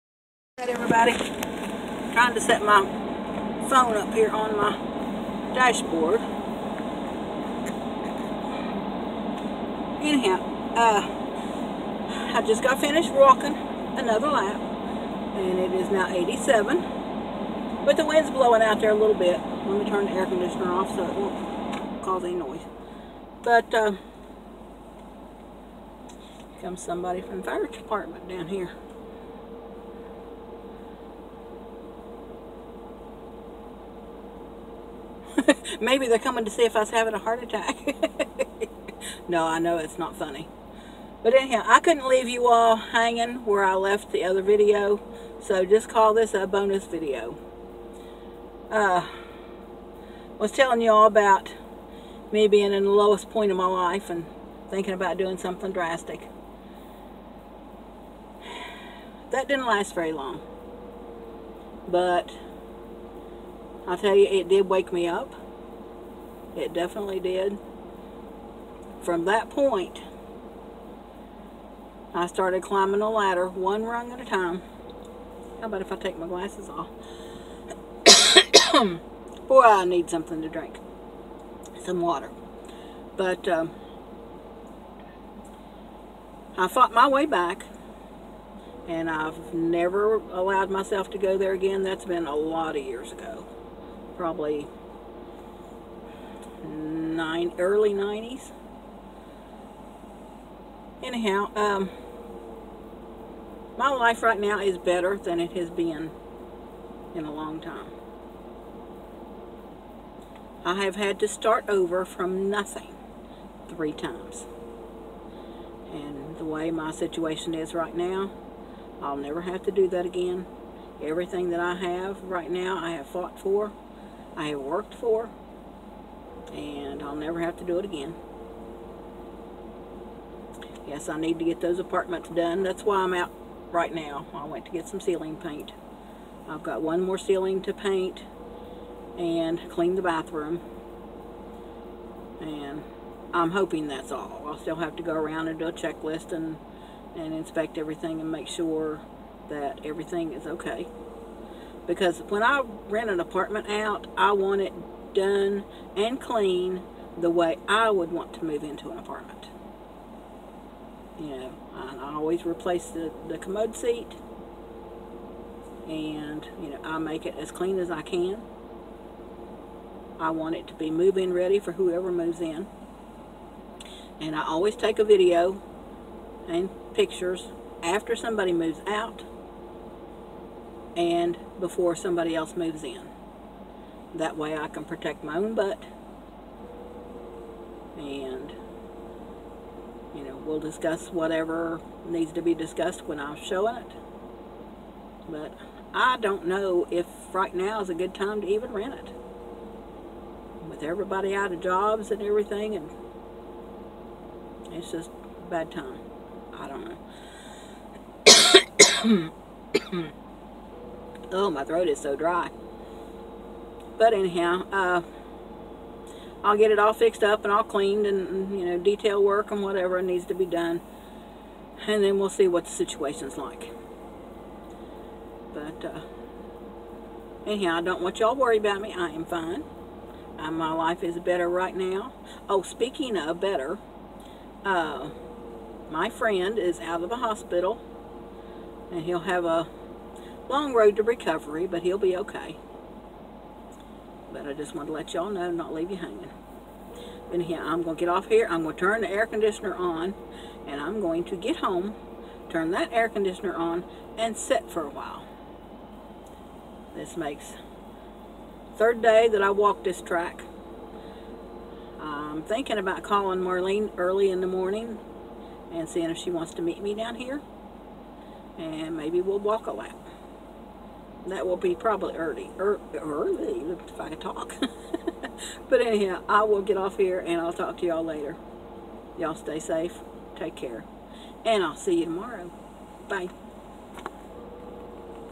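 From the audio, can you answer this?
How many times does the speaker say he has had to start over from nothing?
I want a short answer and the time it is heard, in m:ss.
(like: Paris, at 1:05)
3, at 1:53.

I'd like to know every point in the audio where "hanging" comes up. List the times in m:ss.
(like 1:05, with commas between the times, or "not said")
0:42, 4:05.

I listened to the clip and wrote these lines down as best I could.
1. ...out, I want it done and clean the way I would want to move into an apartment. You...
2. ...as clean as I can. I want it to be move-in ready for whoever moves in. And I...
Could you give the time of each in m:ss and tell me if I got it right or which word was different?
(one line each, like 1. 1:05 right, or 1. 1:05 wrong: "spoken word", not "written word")
1. 2:33 right
2. 2:47 right.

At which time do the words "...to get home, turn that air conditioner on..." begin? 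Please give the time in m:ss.
4:11.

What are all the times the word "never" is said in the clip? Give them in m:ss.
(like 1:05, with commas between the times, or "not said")
1:29, 1:59, 2:07.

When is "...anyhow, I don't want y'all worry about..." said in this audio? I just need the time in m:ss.
3:47.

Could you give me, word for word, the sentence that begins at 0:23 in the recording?
But uh, comes somebody from the fire department down here.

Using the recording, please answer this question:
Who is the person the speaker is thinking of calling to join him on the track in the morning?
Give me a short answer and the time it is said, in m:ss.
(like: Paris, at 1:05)
Marlene, at 4:23.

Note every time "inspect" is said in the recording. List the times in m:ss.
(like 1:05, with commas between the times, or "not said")
2:27.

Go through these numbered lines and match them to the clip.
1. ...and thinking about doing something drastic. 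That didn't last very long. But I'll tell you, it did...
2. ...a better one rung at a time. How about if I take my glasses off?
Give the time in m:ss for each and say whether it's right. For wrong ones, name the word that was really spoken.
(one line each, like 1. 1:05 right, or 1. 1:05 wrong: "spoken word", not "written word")
1. 0:54 right
2. 1:13 wrong: "ladder", not "better".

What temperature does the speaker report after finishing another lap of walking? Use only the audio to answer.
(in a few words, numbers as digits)
87.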